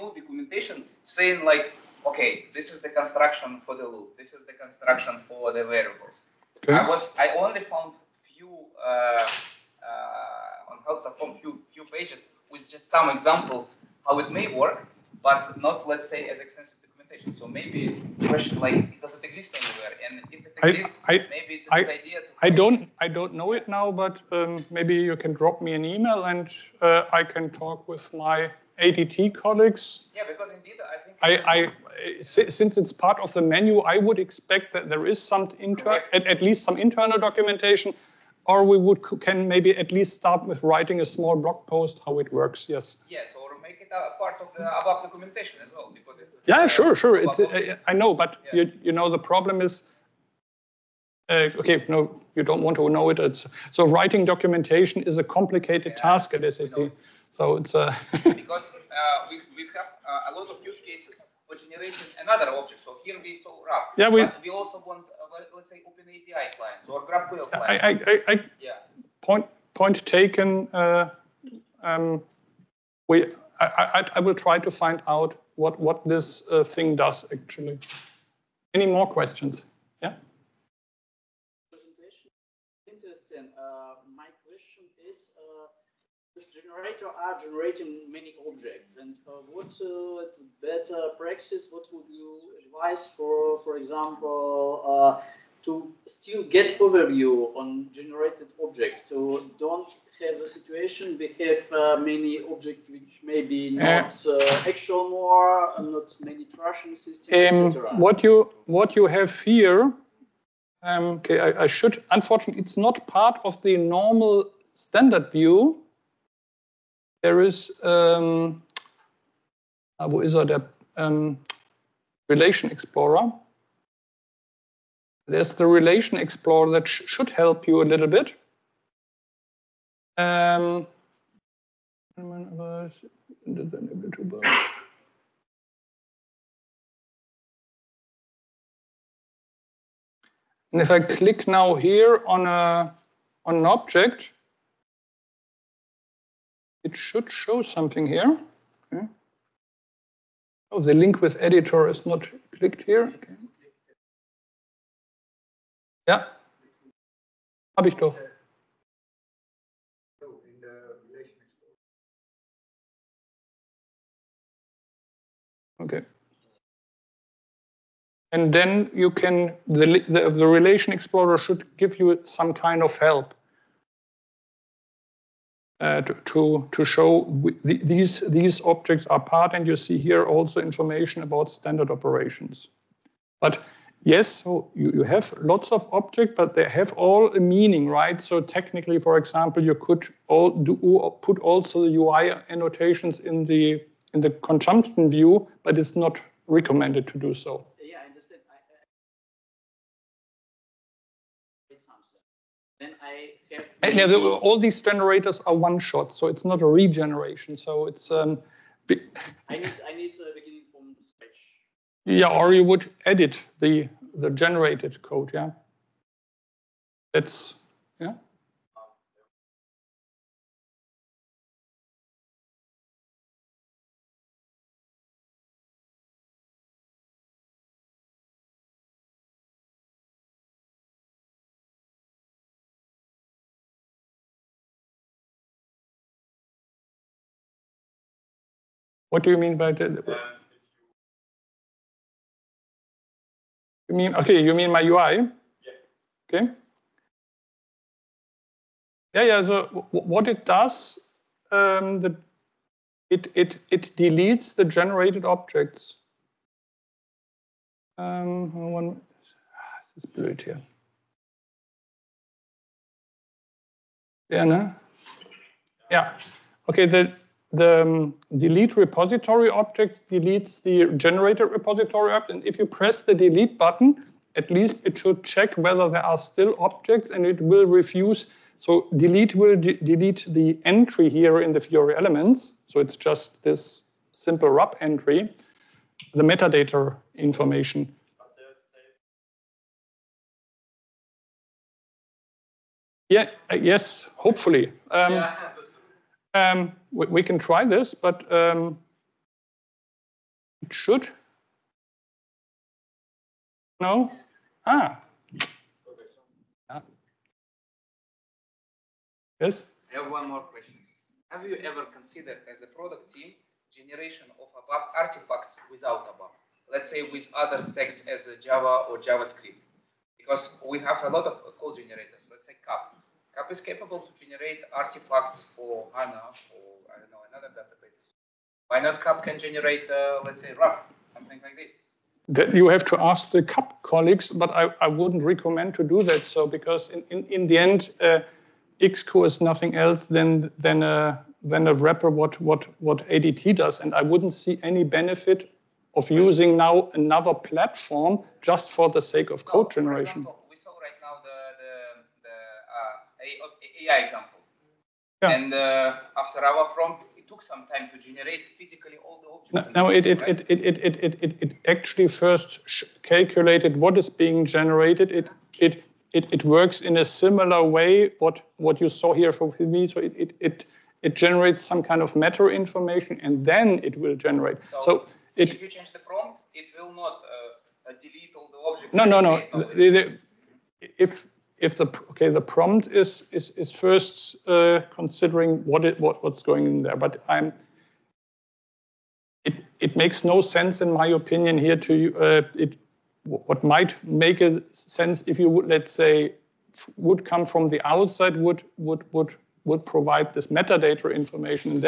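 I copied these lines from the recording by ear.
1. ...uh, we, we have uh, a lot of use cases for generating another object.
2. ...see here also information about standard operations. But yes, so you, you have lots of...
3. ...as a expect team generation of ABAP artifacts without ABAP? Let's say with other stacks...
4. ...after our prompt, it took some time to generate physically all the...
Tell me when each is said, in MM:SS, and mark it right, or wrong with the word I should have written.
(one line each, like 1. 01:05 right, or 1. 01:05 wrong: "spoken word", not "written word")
1. 00:58 right
2. 02:59 right
3. 05:12 wrong: "product", not "expect"
4. 05:56 right.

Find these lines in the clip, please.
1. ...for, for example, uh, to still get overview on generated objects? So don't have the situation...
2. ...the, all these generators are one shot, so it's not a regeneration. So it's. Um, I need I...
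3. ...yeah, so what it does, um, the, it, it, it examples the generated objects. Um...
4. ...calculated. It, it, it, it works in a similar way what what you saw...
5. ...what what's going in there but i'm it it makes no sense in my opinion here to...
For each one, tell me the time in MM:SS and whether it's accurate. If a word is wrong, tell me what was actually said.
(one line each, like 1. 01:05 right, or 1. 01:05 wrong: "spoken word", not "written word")
1. 01:33 right
2. 03:24 right
3. 04:09 wrong: "deletes", not "examples"
4. 06:04 wrong: "generated", not "calculated"
5. 06:25 right.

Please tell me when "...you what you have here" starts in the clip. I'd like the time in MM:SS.
01:48.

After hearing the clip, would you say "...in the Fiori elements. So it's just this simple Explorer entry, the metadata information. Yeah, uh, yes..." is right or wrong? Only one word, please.
wrong.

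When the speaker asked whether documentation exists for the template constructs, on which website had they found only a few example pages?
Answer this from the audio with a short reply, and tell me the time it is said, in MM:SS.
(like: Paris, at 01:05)
help.com, at 00:10.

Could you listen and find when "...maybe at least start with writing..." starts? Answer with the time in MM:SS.
00:39.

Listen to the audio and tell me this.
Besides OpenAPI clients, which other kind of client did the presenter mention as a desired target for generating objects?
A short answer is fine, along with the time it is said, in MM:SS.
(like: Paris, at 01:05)
GraphQL clients, at 01:07.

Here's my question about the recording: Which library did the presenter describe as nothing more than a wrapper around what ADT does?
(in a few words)
XCO.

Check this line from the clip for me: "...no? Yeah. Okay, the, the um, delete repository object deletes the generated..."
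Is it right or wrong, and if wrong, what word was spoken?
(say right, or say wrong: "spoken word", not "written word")
right.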